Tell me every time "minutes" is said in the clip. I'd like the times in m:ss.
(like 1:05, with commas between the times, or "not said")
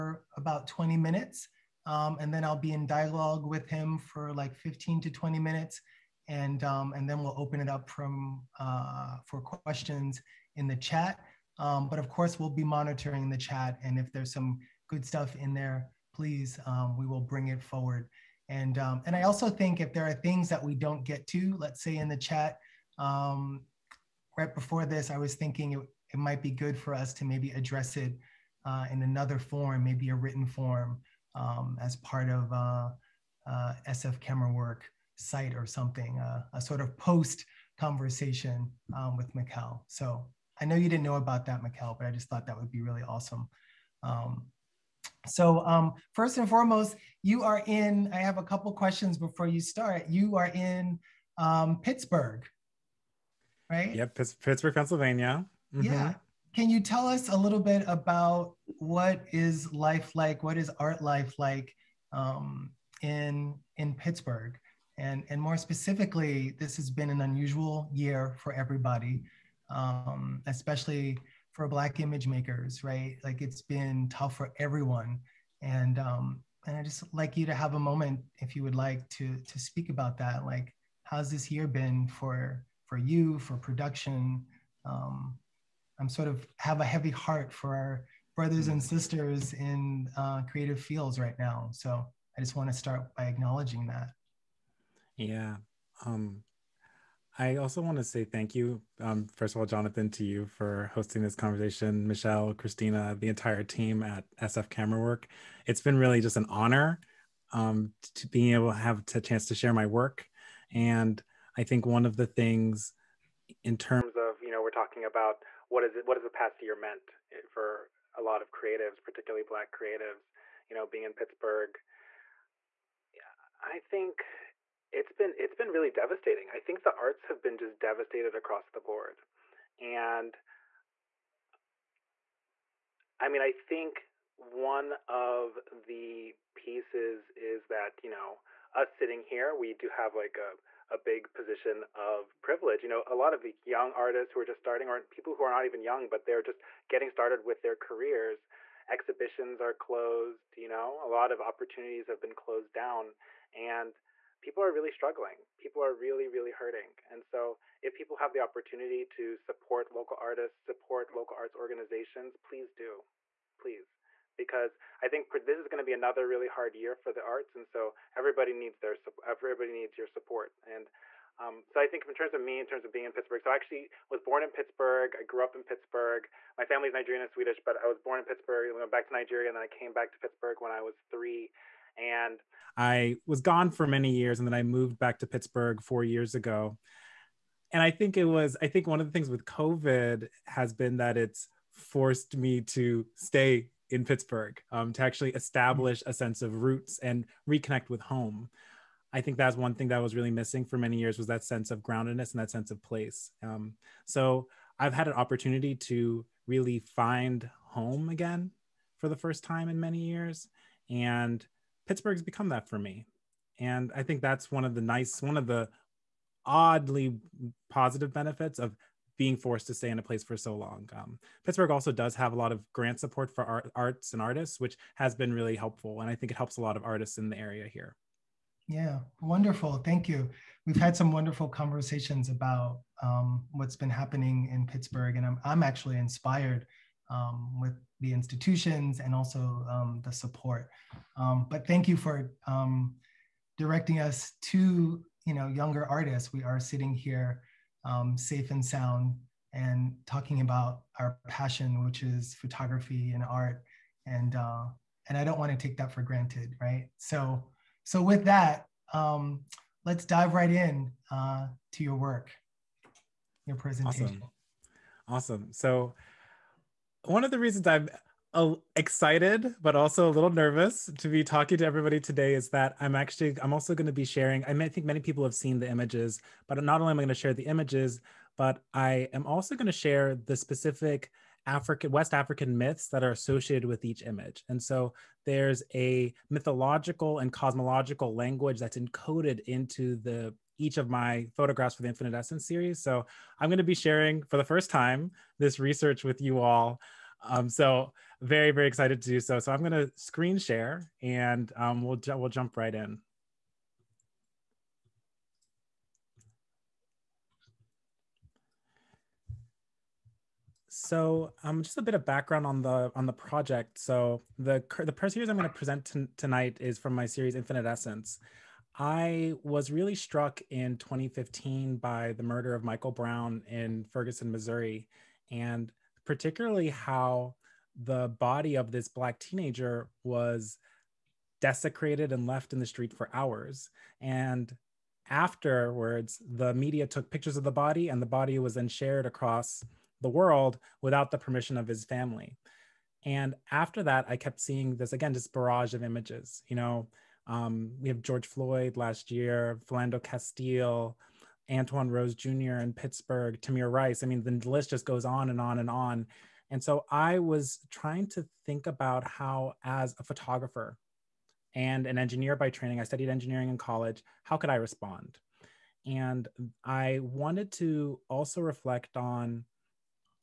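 0:00, 0:05.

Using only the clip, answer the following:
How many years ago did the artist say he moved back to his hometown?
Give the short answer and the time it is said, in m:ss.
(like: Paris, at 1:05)
4, at 3:05.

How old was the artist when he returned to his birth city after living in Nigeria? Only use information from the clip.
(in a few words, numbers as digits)
3.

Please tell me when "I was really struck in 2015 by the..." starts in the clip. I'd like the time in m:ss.
5:18.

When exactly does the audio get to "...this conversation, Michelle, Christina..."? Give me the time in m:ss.
1:41.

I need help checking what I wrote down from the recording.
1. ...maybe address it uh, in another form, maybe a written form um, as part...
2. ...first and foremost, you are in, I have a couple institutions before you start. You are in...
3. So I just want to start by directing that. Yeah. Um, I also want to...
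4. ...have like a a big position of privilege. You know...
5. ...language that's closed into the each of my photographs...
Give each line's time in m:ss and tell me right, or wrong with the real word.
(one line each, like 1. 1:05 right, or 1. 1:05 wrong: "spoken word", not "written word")
1. 0:27 right
2. 0:46 wrong: "questions", not "institutions"
3. 1:31 wrong: "acknowledging", not "directing"
4. 2:19 right
5. 4:48 wrong: "encoded", not "closed".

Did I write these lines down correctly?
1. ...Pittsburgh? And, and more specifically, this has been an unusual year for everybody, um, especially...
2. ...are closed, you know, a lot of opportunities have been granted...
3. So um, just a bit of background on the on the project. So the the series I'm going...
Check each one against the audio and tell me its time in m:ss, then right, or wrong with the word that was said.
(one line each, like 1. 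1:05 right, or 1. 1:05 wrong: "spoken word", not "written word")
1. 1:03 right
2. 2:29 wrong: "closed", not "granted"
3. 5:10 right.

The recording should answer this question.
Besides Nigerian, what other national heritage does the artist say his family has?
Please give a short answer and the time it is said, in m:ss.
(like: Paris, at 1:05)
Swedish, at 2:57.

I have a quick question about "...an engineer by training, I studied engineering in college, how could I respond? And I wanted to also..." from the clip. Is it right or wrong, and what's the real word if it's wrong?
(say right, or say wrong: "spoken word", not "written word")
right.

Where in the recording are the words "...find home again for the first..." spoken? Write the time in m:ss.
3:26.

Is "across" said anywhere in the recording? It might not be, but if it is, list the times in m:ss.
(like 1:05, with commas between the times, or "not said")
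2:08, 5:39.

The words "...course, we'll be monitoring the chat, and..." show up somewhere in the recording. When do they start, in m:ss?
0:12.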